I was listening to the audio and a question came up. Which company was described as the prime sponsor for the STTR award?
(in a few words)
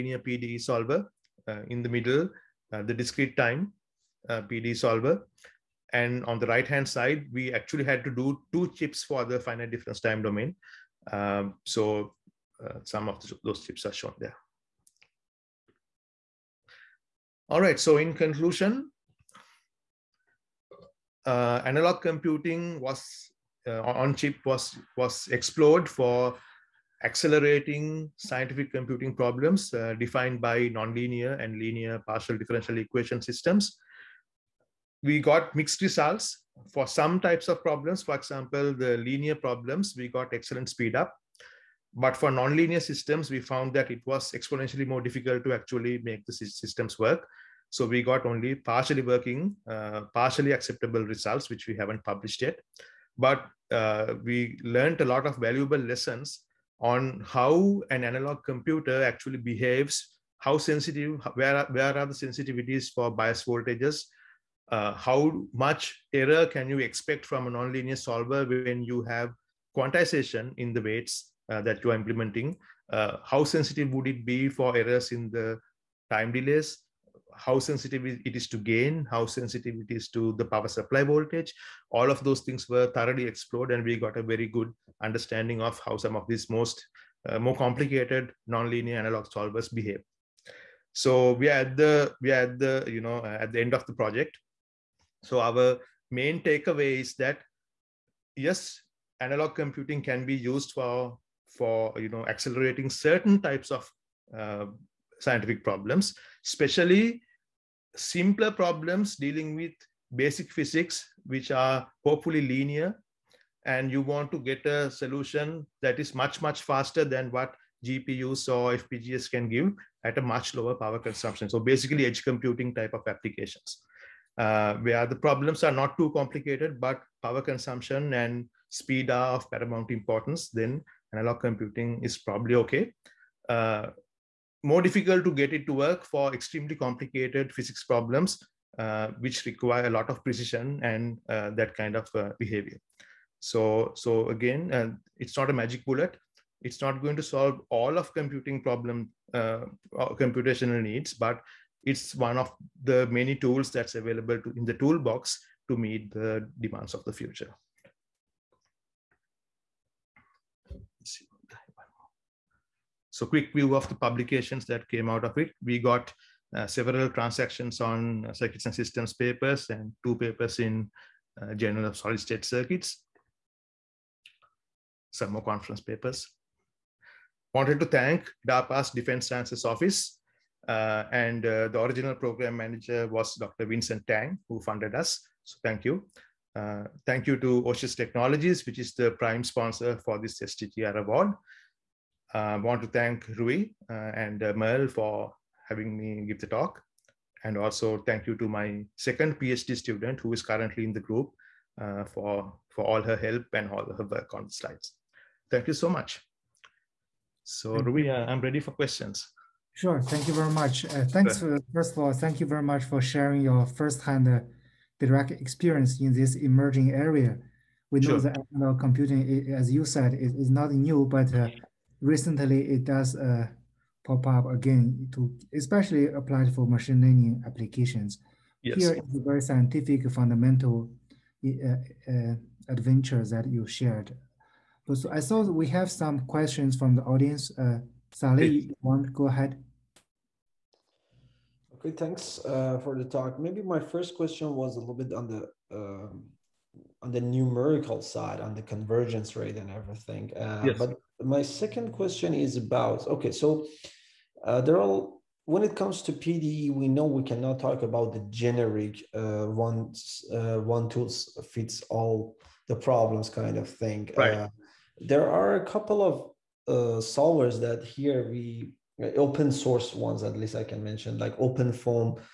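Oshis Technologies.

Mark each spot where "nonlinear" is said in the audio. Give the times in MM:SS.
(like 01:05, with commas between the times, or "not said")
00:30, 00:42, 01:07, 01:28.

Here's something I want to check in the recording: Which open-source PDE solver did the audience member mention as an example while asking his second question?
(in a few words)
OpenFoam.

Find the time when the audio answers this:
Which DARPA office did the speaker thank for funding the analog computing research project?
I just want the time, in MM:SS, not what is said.
02:58.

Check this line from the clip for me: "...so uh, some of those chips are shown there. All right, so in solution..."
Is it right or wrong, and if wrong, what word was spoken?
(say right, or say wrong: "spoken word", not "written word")
wrong: "conclusion", not "solution".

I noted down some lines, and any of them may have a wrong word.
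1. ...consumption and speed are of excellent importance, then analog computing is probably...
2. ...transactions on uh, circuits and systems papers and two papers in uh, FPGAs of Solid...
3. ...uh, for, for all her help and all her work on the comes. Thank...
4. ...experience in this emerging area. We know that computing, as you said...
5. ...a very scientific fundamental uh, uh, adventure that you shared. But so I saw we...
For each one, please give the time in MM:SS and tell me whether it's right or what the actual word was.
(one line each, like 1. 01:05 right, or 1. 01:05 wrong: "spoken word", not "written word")
1. 02:07 wrong: "paramount", not "excellent"
2. 02:47 wrong: "Journal", not "FPGAs"
3. 03:21 wrong: "slides", not "comes"
4. 03:35 right
5. 03:49 right.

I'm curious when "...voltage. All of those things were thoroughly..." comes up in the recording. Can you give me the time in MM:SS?
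01:21.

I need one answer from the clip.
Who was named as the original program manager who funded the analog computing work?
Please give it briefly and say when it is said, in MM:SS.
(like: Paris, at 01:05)
Dr. Vincent Tang, at 03:03.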